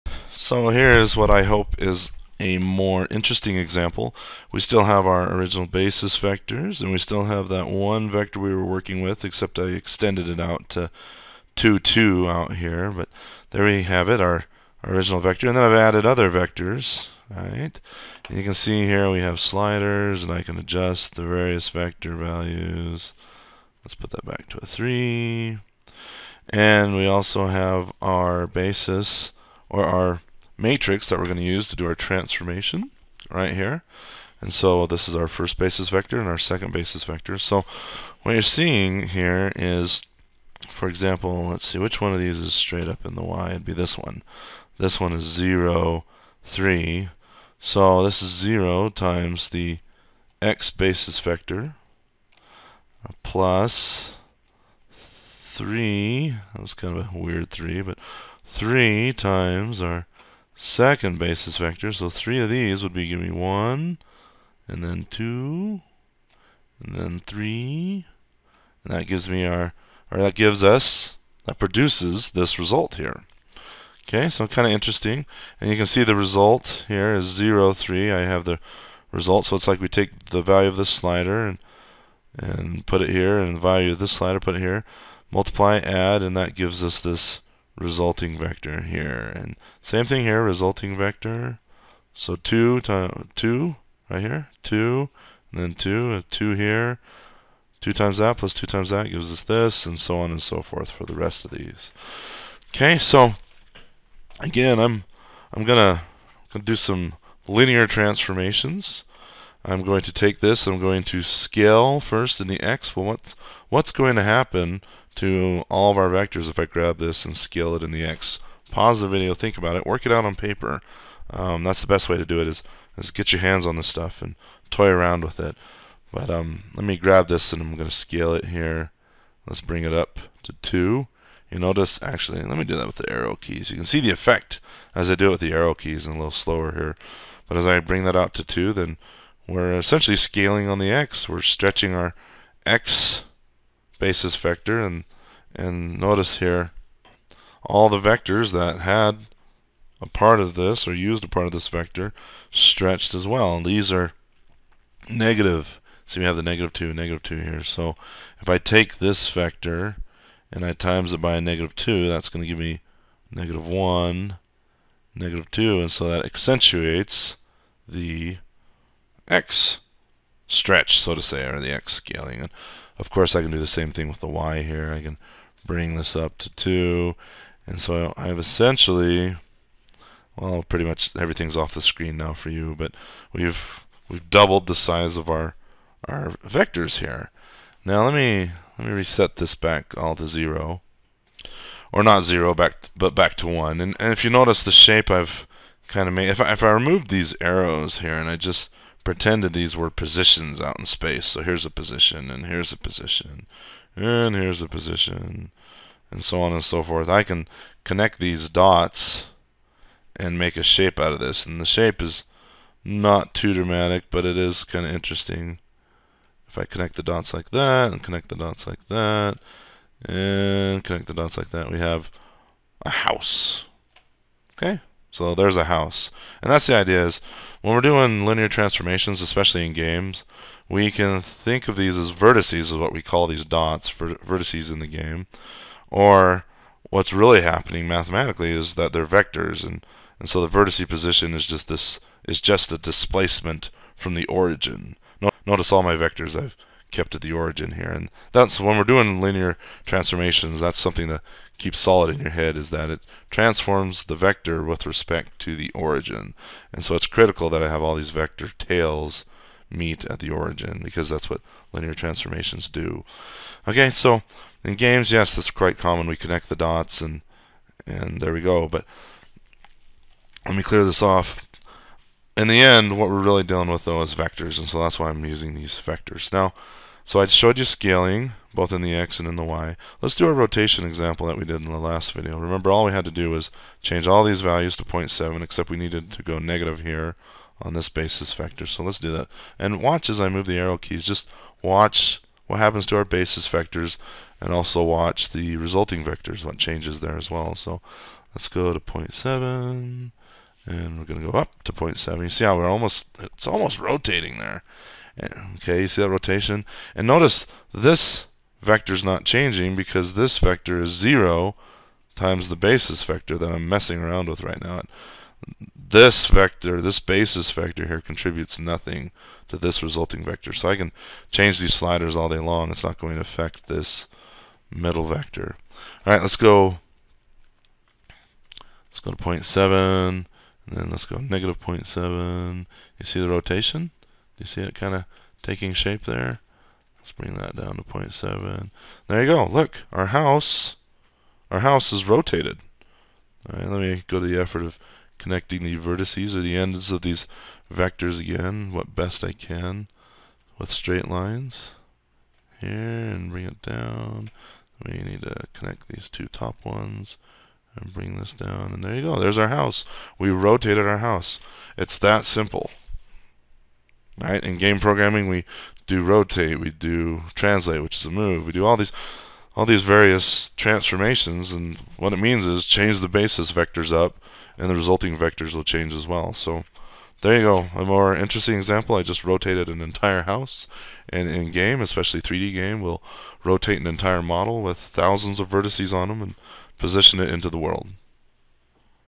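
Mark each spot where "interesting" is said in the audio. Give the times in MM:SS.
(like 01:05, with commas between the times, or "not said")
00:03, 01:14, 03:34, 06:18.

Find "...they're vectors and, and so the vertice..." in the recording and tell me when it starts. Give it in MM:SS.
03:58.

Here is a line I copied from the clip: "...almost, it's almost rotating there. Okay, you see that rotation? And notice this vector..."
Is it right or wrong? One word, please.
right.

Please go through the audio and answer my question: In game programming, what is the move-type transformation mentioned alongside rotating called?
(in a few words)
Translate.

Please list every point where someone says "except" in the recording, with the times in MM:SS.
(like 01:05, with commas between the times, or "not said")
00:09, 04:45.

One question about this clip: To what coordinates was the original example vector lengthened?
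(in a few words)
2, 2.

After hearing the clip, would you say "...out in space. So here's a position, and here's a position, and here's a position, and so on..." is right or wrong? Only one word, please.
right.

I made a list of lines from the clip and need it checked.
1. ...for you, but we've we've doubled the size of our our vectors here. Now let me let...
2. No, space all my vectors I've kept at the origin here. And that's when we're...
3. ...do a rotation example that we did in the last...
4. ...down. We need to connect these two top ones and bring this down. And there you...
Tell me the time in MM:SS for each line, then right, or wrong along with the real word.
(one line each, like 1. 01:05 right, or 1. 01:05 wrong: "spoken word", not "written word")
1. 03:02 right
2. 04:05 wrong: "notice", not "space"
3. 04:40 right
4. 05:53 right.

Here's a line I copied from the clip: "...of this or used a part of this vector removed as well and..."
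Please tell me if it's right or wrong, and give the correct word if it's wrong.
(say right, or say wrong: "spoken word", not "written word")
wrong: "stretched", not "removed".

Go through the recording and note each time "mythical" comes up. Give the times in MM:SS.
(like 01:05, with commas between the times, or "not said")
not said.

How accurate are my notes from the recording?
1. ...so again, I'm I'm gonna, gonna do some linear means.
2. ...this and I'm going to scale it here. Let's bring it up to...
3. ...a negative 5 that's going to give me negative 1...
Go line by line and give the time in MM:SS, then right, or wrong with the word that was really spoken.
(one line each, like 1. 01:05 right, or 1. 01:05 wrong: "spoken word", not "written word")
1. 01:42 wrong: "transformations", not "means"
2. 02:07 right
3. 02:41 wrong: "2", not "5".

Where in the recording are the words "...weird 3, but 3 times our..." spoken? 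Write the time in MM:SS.
00:57.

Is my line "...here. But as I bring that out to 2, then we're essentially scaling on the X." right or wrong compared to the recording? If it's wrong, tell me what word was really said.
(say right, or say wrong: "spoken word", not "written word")
right.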